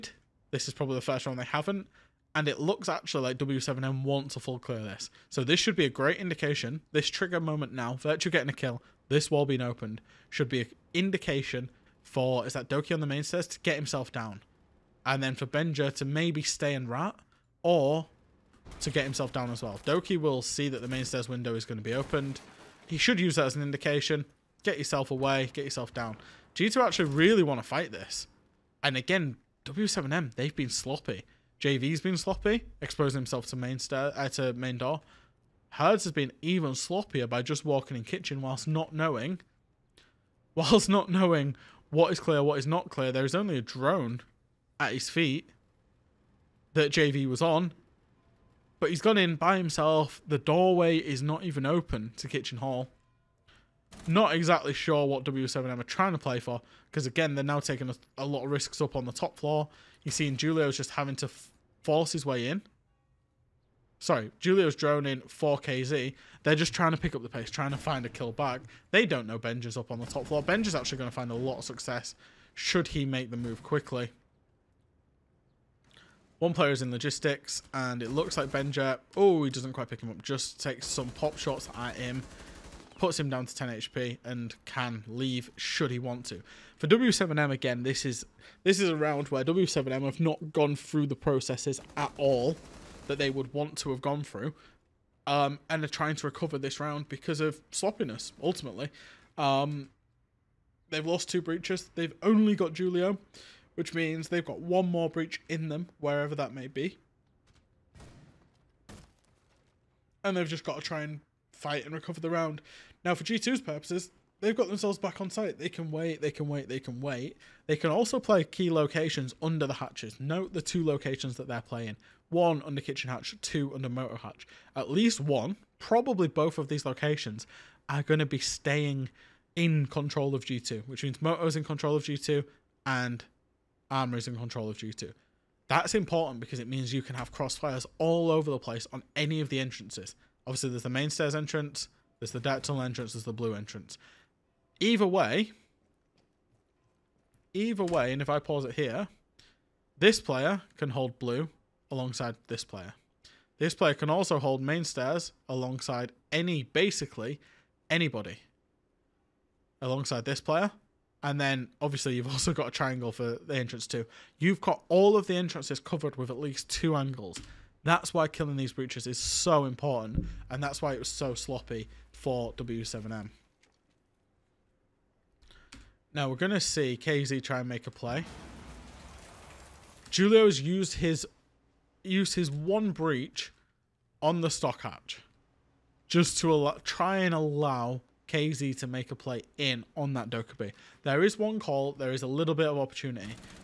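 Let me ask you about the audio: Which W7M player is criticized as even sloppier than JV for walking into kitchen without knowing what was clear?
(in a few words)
Herds.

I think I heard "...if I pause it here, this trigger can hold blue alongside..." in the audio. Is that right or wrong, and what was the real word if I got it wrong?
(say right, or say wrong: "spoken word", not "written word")
wrong: "player", not "trigger".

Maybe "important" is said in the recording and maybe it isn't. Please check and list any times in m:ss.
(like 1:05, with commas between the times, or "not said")
2:15, 2:49.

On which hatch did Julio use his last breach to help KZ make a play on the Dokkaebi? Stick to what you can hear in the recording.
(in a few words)
Stock hatch.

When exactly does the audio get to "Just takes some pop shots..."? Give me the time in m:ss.
1:20.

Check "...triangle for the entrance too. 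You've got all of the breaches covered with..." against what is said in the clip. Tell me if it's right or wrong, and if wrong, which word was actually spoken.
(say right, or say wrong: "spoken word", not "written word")
wrong: "entrances", not "breaches".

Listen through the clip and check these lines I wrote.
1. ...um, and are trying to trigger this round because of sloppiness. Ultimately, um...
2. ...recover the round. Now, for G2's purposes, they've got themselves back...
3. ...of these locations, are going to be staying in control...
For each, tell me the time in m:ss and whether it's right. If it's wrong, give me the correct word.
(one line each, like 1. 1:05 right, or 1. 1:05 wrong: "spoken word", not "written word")
1. 1:35 wrong: "recover", not "trigger"
2. 1:51 right
3. 2:06 right.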